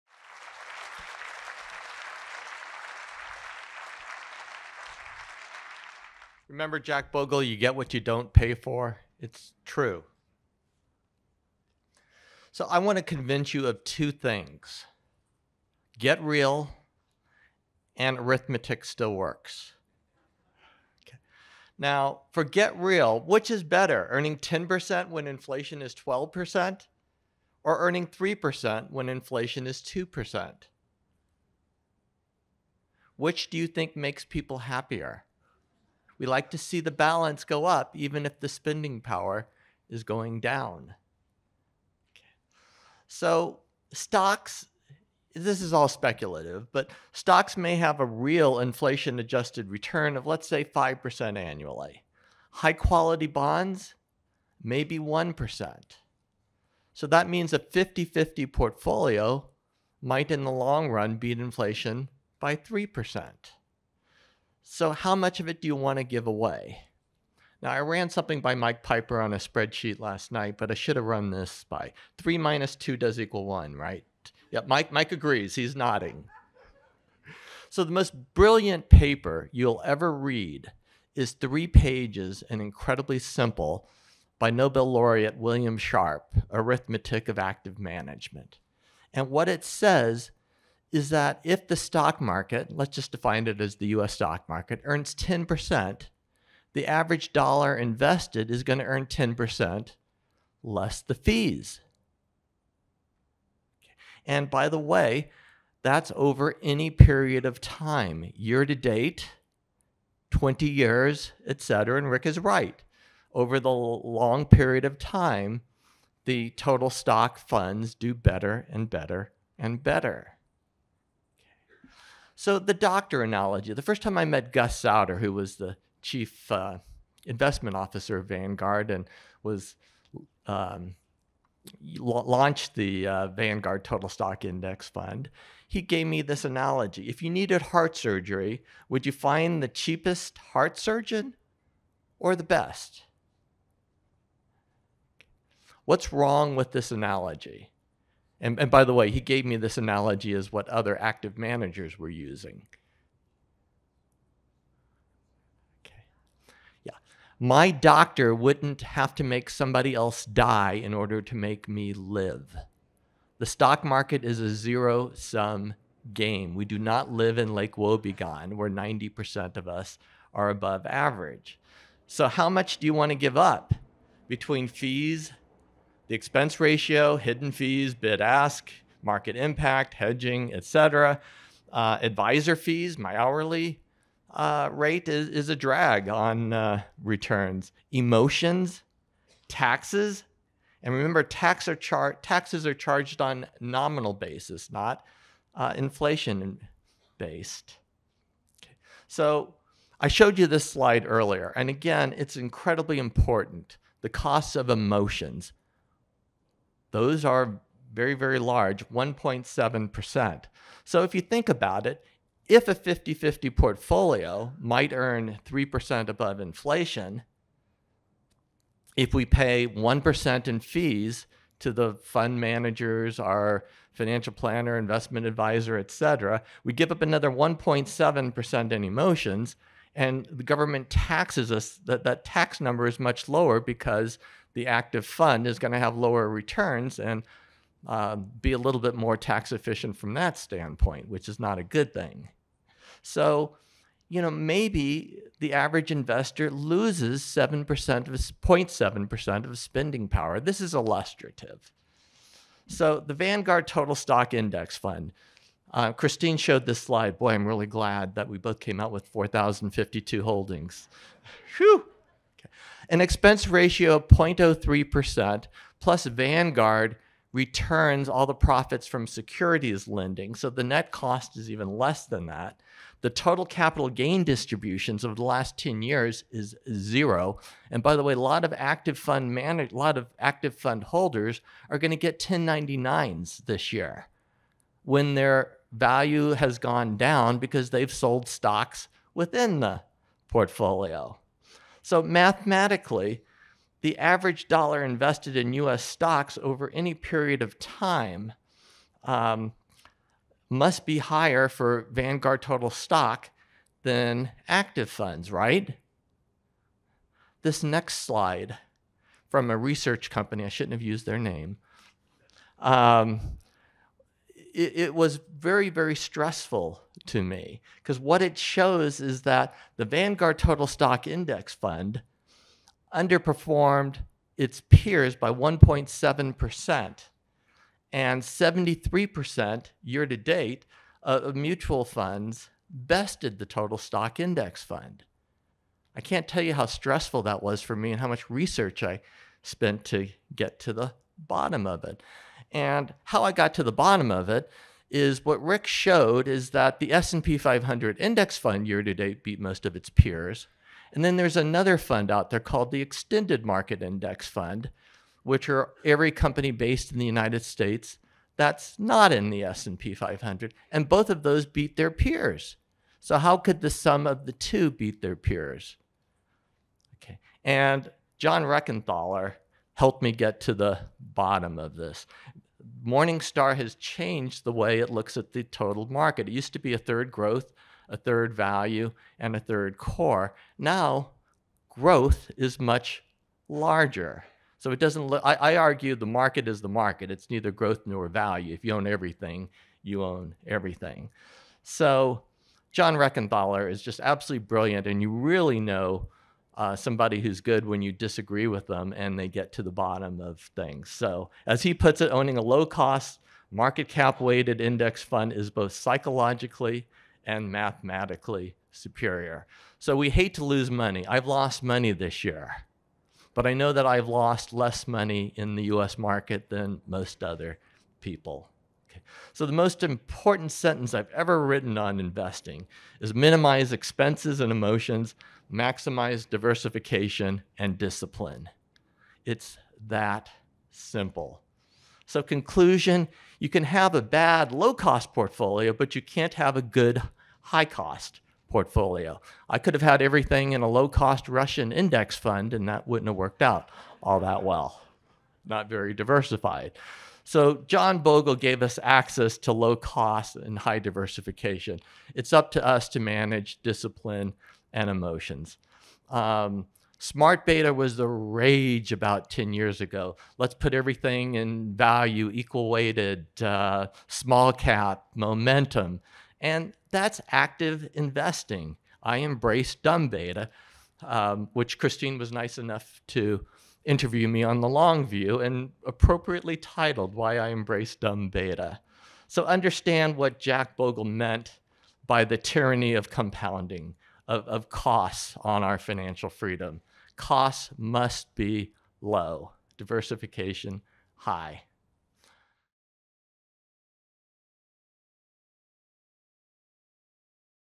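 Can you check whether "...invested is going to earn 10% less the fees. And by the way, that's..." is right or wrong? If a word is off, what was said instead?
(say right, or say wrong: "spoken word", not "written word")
right.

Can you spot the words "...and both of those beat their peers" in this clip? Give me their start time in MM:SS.
06:00.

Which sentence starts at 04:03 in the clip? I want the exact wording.
So, you know, maybe the average investor loses 7% of 0.7% of spending power.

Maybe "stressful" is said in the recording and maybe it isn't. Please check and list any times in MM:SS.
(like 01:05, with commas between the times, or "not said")
05:15, 05:36.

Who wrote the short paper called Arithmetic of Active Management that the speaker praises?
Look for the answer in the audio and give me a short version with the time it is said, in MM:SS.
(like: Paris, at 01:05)
William Sharpe, at 01:25.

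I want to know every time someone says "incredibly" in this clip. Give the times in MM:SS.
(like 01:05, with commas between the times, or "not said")
01:22, 03:22.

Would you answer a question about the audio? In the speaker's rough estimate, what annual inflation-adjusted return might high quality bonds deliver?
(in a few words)
1%.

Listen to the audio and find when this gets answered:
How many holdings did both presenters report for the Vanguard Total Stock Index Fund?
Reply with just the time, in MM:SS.
04:19.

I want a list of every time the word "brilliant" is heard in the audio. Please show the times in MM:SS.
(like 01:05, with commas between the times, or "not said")
01:18, 06:34.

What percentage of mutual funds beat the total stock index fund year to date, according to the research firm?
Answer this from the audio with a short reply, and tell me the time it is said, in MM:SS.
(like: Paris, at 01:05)
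73%, at 05:28.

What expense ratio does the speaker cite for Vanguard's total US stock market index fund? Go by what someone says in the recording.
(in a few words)
0.03%.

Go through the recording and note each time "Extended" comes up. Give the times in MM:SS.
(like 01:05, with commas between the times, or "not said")
05:52.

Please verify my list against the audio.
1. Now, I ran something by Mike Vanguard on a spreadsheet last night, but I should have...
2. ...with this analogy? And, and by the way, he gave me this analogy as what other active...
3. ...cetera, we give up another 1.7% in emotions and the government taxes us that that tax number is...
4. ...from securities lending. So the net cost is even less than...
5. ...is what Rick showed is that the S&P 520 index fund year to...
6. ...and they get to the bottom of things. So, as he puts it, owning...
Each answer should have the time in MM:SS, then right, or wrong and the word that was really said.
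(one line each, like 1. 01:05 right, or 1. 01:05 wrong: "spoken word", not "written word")
1. 01:07 wrong: "Piper", not "Vanguard"
2. 02:26 right
3. 03:45 right
4. 04:28 right
5. 05:44 wrong: "500", not "520"
6. 06:38 right.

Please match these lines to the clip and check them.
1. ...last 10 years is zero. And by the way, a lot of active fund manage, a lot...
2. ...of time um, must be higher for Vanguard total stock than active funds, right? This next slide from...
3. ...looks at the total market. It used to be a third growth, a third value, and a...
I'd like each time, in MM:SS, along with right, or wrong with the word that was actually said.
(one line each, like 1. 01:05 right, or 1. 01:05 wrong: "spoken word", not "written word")
1. 04:35 right
2. 04:57 right
3. 06:14 right.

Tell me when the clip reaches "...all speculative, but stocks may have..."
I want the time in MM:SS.
00:45.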